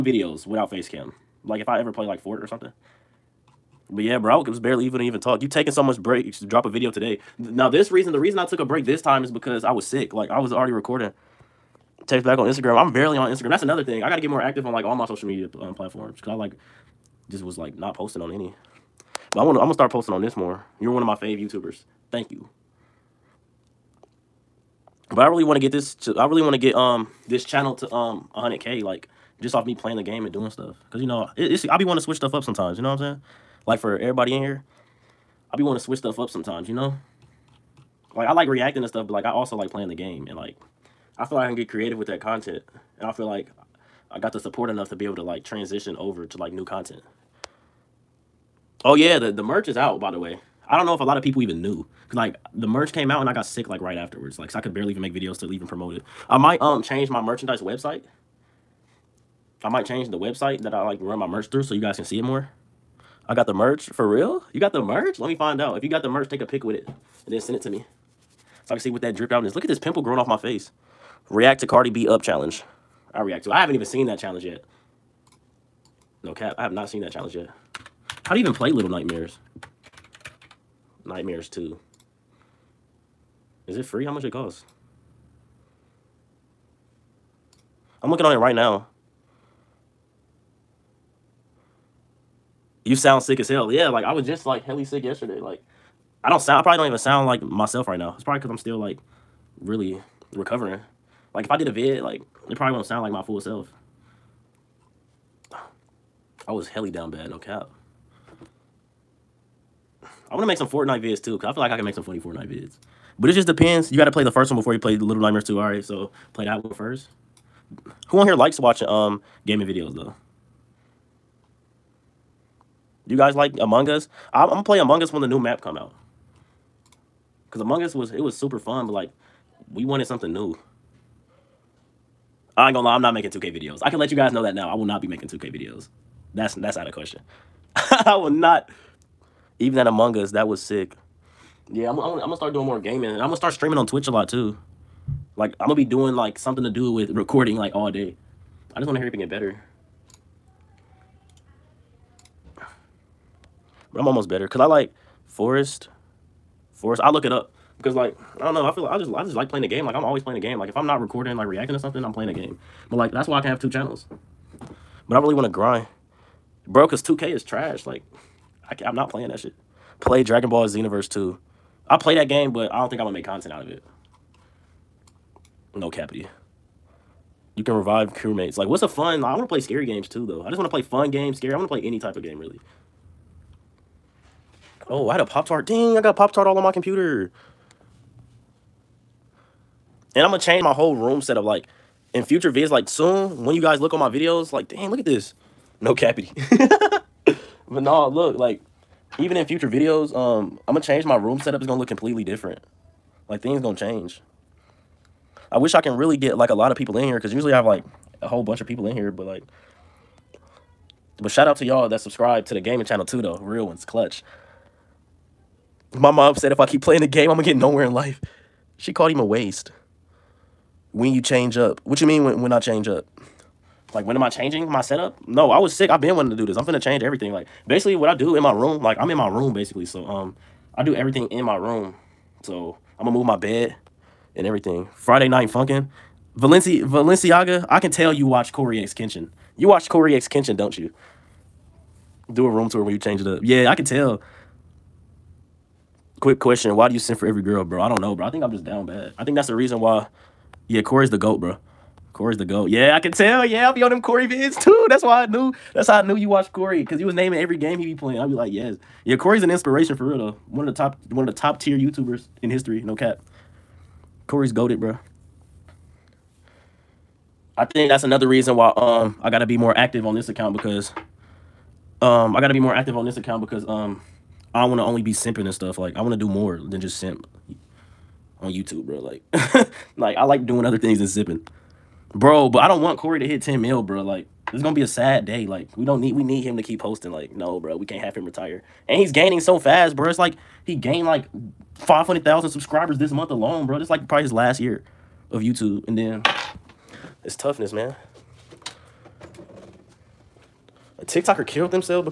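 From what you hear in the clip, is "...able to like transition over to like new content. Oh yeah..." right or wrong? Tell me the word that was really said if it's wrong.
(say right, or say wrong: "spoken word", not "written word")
right.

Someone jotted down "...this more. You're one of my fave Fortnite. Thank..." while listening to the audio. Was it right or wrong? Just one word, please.
wrong.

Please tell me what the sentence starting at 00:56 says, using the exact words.
I might um change my merchandise website.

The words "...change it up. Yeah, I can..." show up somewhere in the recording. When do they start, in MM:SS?
04:02.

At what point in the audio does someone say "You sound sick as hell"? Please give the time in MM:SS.
01:32.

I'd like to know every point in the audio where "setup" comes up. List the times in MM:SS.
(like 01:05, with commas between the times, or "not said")
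03:11, 03:21, 03:44.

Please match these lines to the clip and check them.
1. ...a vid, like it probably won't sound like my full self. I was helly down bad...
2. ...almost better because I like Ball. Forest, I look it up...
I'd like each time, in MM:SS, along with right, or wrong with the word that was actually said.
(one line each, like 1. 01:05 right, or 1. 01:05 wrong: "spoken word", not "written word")
1. 01:41 right
2. 02:34 wrong: "Forest", not "Ball".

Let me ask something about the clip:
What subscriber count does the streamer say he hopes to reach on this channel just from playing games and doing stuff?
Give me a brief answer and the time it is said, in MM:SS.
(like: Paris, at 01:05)
100k, at 00:28.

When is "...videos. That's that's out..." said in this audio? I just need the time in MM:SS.
02:15.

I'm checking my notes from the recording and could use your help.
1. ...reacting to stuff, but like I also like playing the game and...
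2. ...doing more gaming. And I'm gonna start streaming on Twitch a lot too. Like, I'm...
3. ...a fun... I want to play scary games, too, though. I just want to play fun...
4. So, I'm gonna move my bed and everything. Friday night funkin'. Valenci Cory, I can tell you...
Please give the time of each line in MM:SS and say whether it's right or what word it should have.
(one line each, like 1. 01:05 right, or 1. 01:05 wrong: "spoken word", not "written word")
1. 00:38 right
2. 02:22 right
3. 02:58 right
4. 03:52 wrong: "Valenciaga", not "Cory".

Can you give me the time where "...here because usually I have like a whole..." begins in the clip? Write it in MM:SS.
03:27.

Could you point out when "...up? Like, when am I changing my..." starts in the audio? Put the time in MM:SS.
03:42.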